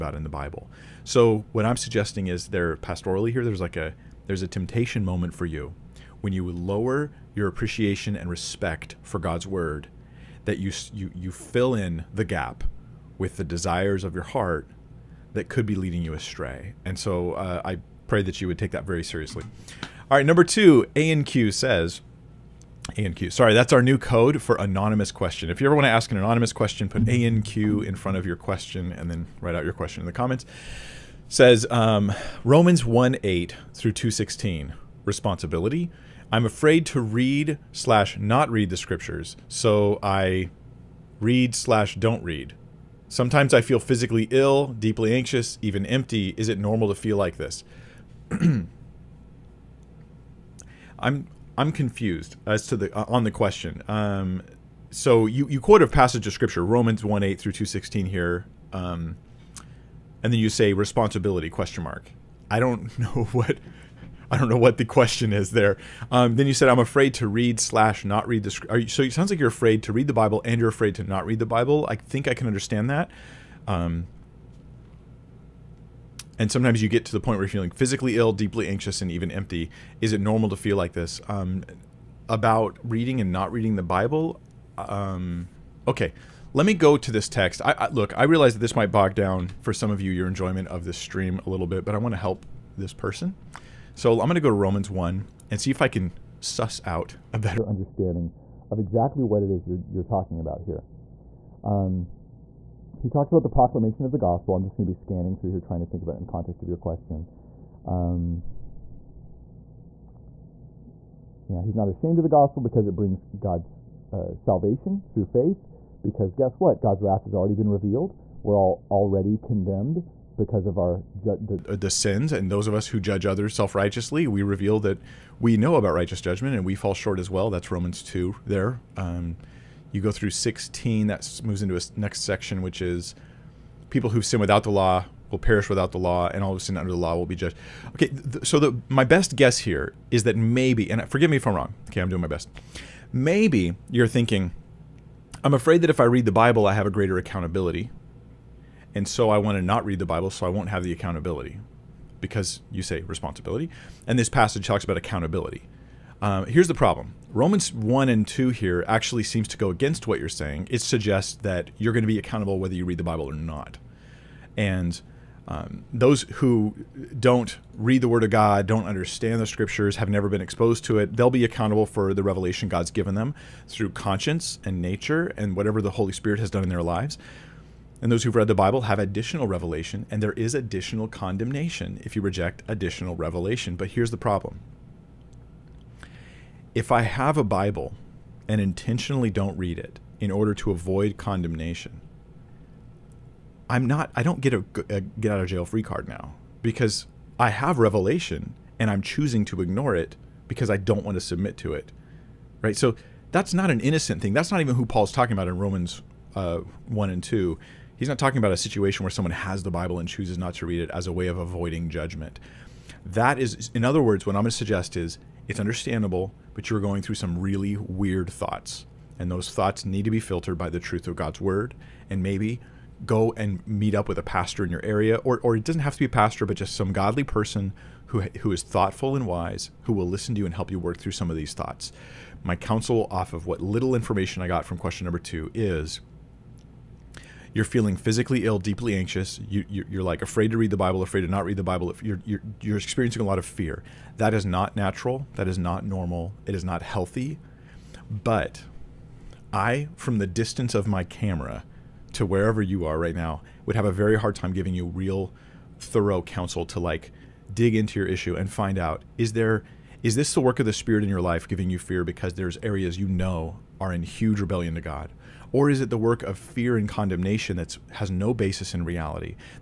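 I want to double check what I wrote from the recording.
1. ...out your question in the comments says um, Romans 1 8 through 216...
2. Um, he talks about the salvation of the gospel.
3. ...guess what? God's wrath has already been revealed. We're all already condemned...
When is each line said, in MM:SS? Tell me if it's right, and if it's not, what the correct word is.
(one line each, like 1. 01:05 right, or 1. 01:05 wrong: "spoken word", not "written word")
1. 00:29 right
2. 01:41 wrong: "proclamation", not "salvation"
3. 01:56 right.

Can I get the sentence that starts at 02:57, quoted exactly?
And those who've read the Bible have additional revelation, and there is additional condemnation if you reject additional revelation.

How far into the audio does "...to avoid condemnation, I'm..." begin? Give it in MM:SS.
03:10.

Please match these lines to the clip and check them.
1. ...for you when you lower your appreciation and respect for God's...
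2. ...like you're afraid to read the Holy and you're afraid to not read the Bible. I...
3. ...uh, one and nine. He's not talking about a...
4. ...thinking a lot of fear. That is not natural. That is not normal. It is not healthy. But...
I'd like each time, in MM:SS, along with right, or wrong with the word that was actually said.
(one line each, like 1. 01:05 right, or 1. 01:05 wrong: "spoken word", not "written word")
1. 00:05 right
2. 01:09 wrong: "Bible", not "Holy"
3. 03:26 wrong: "two", not "nine"
4. 04:02 wrong: "experiencing", not "thinking".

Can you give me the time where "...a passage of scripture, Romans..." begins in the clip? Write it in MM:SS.
00:55.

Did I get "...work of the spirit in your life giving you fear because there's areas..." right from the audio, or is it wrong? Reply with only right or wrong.
right.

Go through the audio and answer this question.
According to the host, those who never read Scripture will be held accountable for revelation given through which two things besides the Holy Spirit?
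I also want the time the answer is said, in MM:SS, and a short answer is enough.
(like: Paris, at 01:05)
conscience and nature, at 02:53.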